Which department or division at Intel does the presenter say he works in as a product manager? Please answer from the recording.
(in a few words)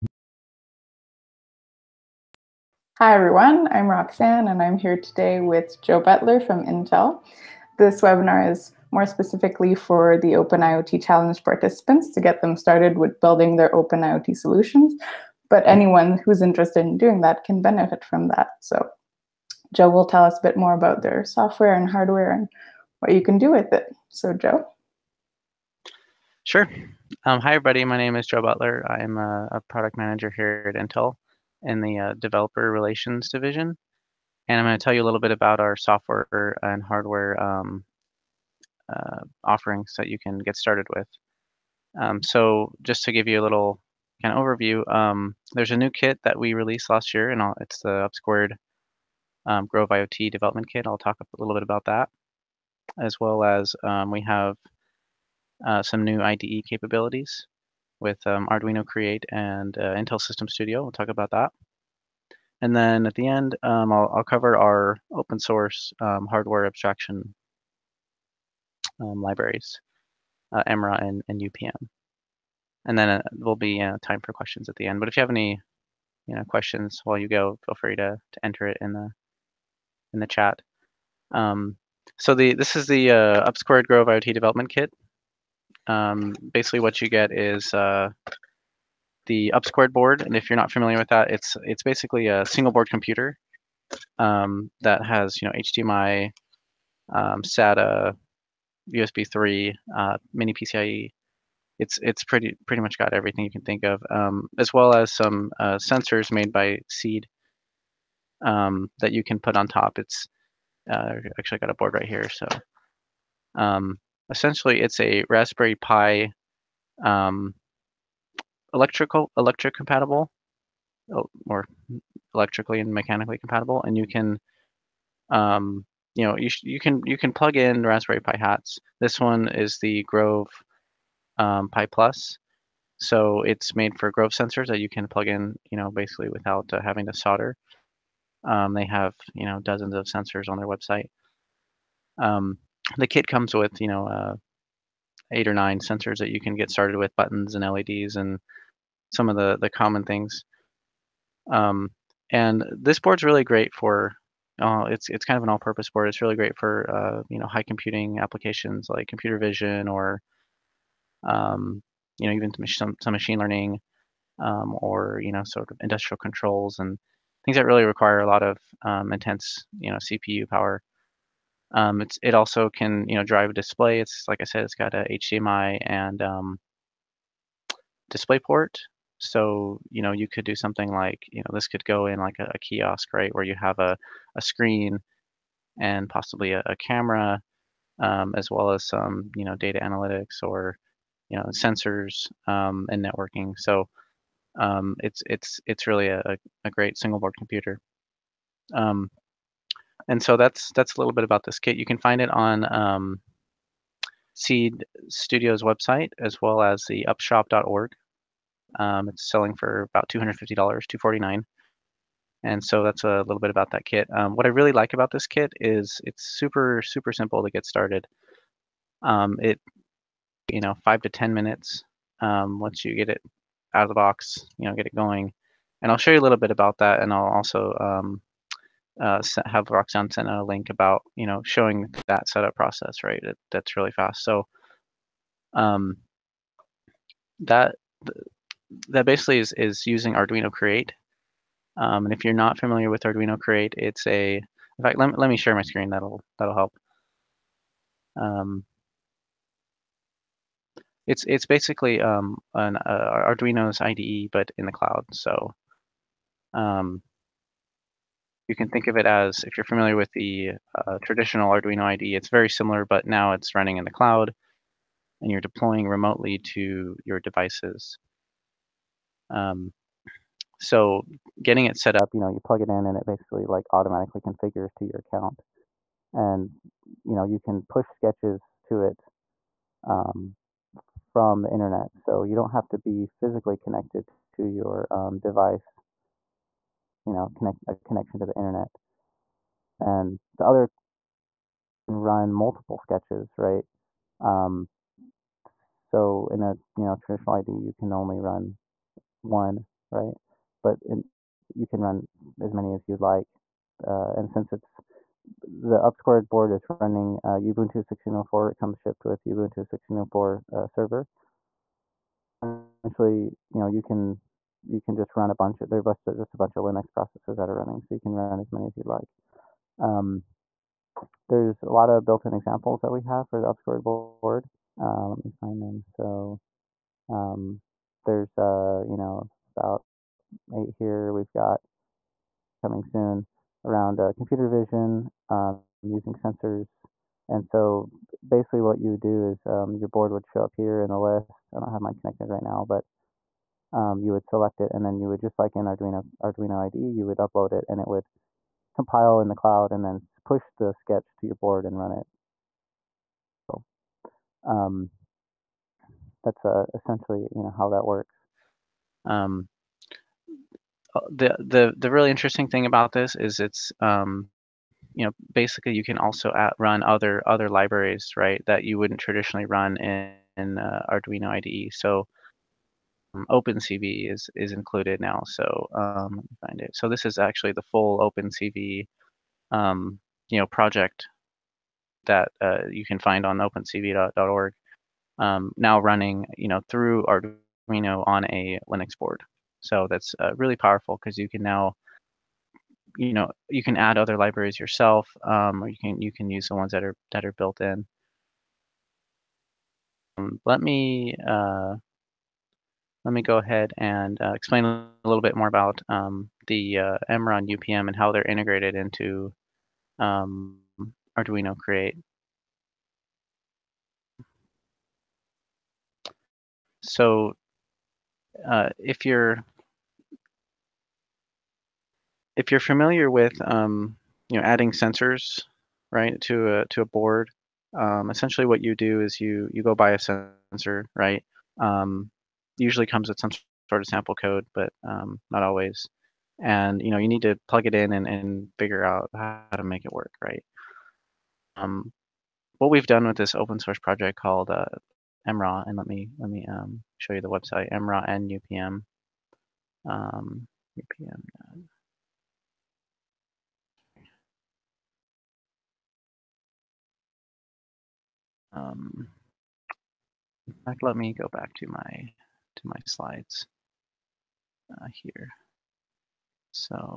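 Developer relations.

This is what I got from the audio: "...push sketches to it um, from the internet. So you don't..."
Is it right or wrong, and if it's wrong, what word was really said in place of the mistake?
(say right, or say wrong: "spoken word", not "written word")
right.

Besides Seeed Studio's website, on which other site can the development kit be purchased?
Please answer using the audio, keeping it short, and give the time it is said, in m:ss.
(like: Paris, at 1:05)
upshop.org, at 3:27.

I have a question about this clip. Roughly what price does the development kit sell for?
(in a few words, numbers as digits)
$249.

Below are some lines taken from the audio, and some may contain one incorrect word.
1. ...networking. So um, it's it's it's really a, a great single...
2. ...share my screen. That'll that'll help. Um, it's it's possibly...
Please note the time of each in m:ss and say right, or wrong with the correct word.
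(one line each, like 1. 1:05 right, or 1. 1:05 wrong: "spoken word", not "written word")
1. 3:13 right
2. 4:05 wrong: "basically", not "possibly".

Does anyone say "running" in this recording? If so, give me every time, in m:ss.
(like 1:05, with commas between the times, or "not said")
4:23, 5:06, 5:17, 6:25.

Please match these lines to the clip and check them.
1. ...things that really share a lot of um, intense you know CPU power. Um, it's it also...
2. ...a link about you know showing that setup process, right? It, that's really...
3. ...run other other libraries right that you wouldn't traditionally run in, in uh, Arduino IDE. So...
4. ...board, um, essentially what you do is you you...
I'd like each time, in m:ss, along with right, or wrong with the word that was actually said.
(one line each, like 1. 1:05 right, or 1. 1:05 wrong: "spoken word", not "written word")
1. 2:47 wrong: "require", not "share"
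2. 3:50 right
3. 6:06 right
4. 7:06 right.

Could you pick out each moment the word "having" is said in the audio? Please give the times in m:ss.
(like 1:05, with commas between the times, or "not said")
2:16.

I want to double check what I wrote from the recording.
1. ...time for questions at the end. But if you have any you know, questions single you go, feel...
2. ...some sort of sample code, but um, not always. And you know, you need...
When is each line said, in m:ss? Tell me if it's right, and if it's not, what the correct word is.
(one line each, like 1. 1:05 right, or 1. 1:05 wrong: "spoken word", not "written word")
1. 1:14 wrong: "while", not "single"
2. 7:13 right.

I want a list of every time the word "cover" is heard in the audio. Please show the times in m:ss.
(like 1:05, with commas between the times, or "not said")
1:04.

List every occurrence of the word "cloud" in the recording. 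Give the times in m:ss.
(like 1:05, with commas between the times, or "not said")
4:14, 4:23, 5:49.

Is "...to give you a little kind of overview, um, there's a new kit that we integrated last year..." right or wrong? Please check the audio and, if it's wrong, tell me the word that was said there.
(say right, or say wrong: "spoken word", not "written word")
wrong: "released", not "integrated".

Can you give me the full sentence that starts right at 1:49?
It's uh, actually got a board right here, so.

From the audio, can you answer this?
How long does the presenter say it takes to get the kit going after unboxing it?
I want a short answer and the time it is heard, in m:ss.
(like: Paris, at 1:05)
5 to 10 minutes, at 3:40.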